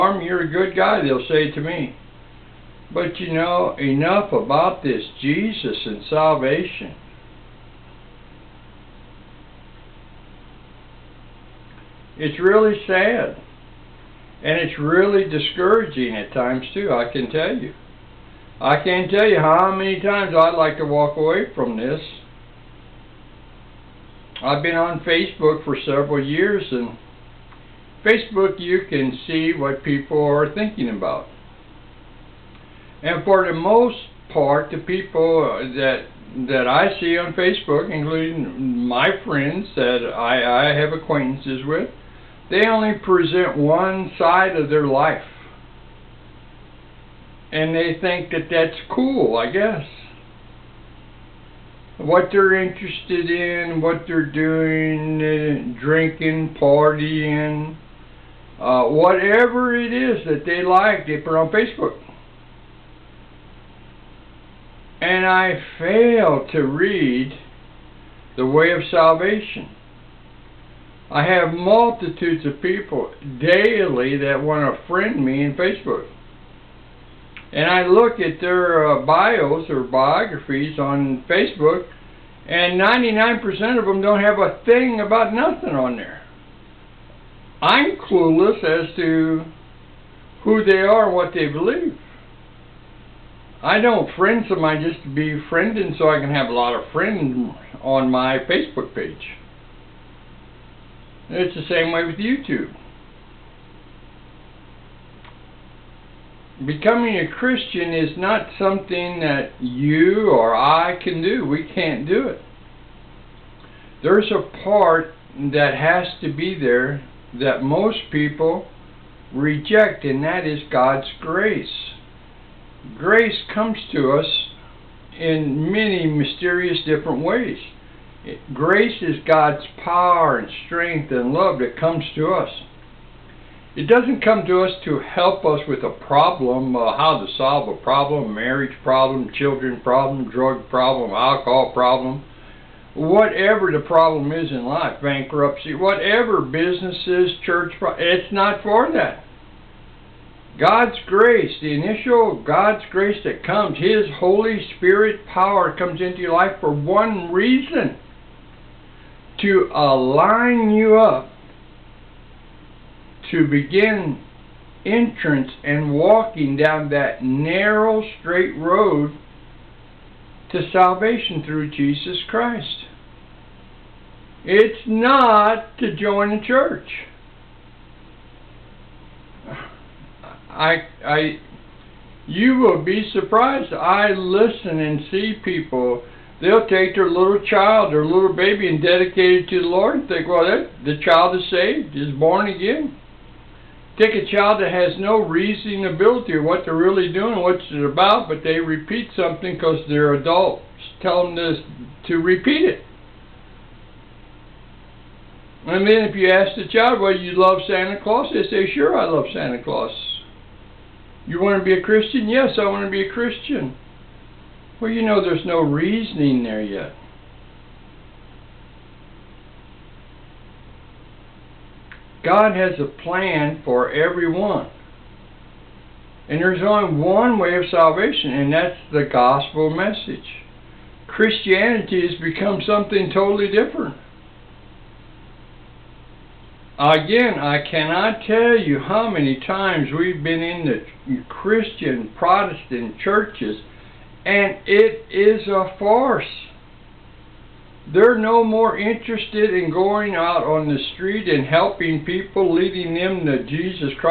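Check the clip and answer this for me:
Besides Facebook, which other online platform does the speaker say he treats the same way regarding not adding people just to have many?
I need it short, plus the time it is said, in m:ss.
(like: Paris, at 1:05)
YouTube, at 1:42.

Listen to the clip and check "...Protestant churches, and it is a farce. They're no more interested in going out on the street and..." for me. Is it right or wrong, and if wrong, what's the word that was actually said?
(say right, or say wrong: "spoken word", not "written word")
right.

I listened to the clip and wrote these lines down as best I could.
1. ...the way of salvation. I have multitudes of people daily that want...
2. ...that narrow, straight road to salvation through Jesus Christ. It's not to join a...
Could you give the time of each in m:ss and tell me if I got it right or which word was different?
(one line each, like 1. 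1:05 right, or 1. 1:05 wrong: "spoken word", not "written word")
1. 1:08 right
2. 2:46 right.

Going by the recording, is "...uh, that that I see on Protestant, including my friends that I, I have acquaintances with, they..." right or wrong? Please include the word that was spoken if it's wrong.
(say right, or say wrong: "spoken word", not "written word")
wrong: "Facebook", not "Protestant".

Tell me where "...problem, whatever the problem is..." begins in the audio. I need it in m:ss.
2:21.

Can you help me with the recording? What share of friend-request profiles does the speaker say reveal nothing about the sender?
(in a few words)
99%.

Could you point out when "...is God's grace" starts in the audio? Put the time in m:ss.
2:00.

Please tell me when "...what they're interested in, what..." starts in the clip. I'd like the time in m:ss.
0:51.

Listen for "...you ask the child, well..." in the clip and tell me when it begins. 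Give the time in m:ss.
3:26.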